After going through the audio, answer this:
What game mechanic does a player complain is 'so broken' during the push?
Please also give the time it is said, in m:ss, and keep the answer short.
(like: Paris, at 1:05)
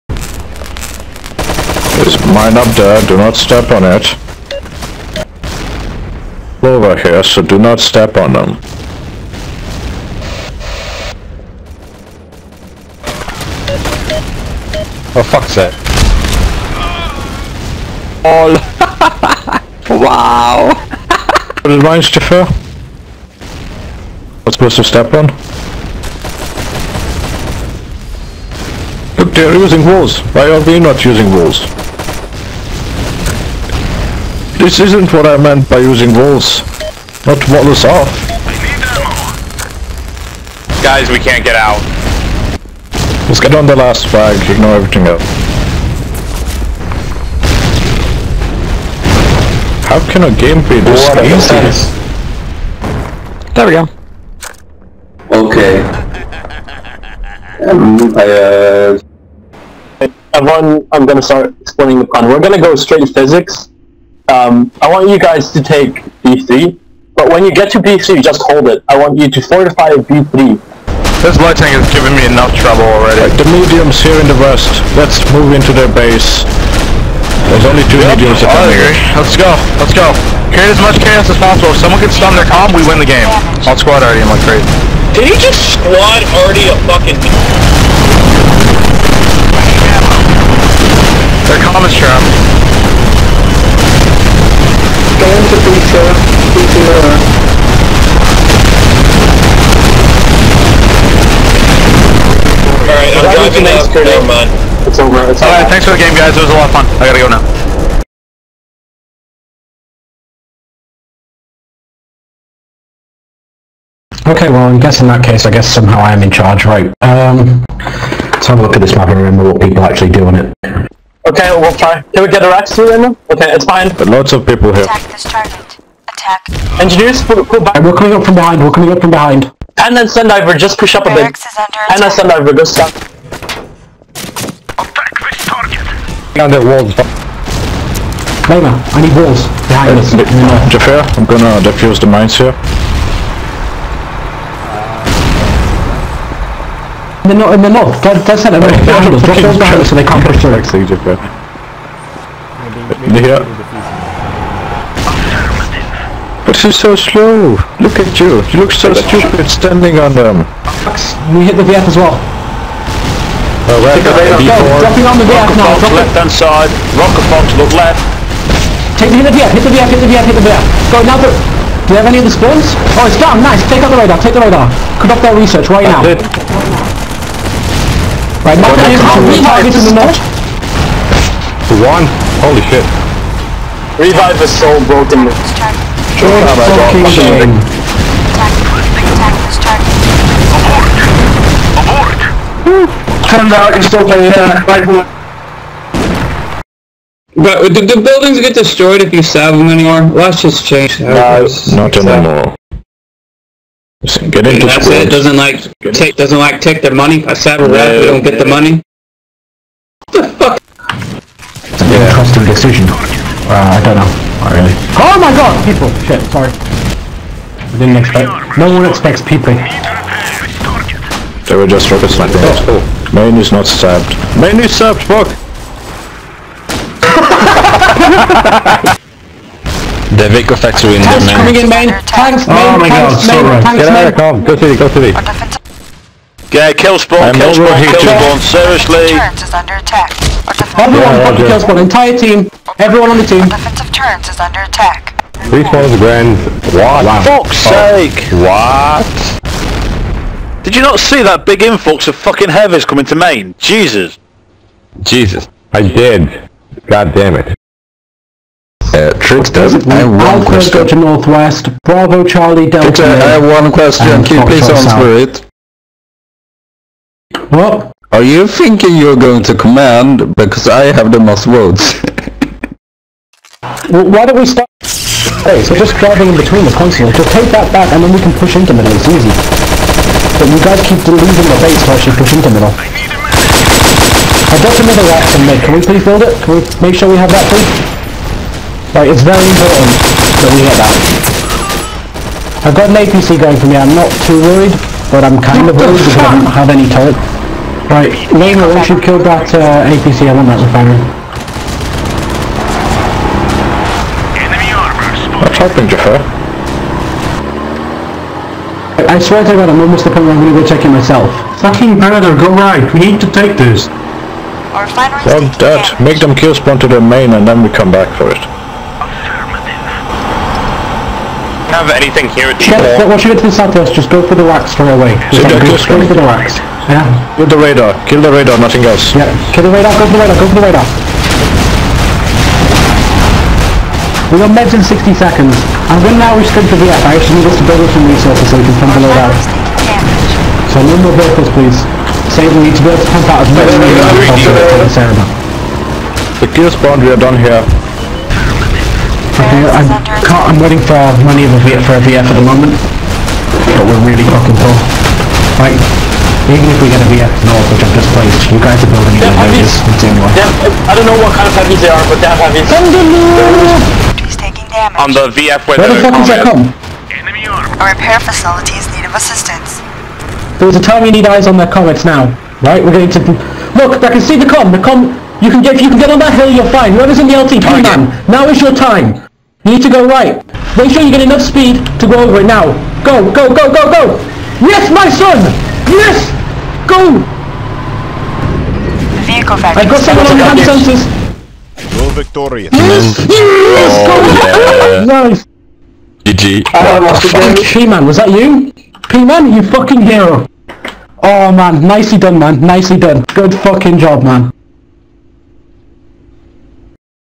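Revive, at 3:03.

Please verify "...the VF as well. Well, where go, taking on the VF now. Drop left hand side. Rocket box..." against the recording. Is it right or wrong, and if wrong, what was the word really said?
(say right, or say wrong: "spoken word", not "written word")
wrong: "dropping", not "taking".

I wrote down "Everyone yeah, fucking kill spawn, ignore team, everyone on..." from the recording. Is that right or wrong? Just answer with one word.
wrong.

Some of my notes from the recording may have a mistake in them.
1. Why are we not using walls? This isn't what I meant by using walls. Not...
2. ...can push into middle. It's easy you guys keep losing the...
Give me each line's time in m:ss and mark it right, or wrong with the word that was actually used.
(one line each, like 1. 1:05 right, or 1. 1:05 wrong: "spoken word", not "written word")
1. 0:30 right
2. 4:38 right.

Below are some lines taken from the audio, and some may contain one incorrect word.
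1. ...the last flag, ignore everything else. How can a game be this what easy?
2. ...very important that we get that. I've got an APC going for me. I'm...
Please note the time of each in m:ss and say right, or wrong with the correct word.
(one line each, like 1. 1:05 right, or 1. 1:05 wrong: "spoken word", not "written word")
1. 0:43 right
2. 4:49 right.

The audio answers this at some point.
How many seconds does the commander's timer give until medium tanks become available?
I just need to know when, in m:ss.
5:34.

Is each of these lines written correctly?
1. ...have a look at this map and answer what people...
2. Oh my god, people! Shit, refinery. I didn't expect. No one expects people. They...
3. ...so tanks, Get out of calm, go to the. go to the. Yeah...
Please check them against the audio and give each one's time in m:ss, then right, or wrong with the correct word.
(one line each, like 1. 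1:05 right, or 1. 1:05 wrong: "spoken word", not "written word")
1. 1:58 wrong: "remember", not "answer"
2. 3:34 wrong: "sorry", not "refinery"
3. 3:53 right.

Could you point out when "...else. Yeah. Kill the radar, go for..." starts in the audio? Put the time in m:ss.
5:28.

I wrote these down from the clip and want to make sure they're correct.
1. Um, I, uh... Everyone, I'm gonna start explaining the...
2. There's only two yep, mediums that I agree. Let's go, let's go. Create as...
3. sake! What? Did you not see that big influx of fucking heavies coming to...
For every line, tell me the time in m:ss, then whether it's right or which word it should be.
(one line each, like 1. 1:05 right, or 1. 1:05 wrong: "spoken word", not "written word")
1. 0:57 right
2. 1:17 right
3. 4:07 right.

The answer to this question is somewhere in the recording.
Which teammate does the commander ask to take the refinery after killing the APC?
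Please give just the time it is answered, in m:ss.
4:58.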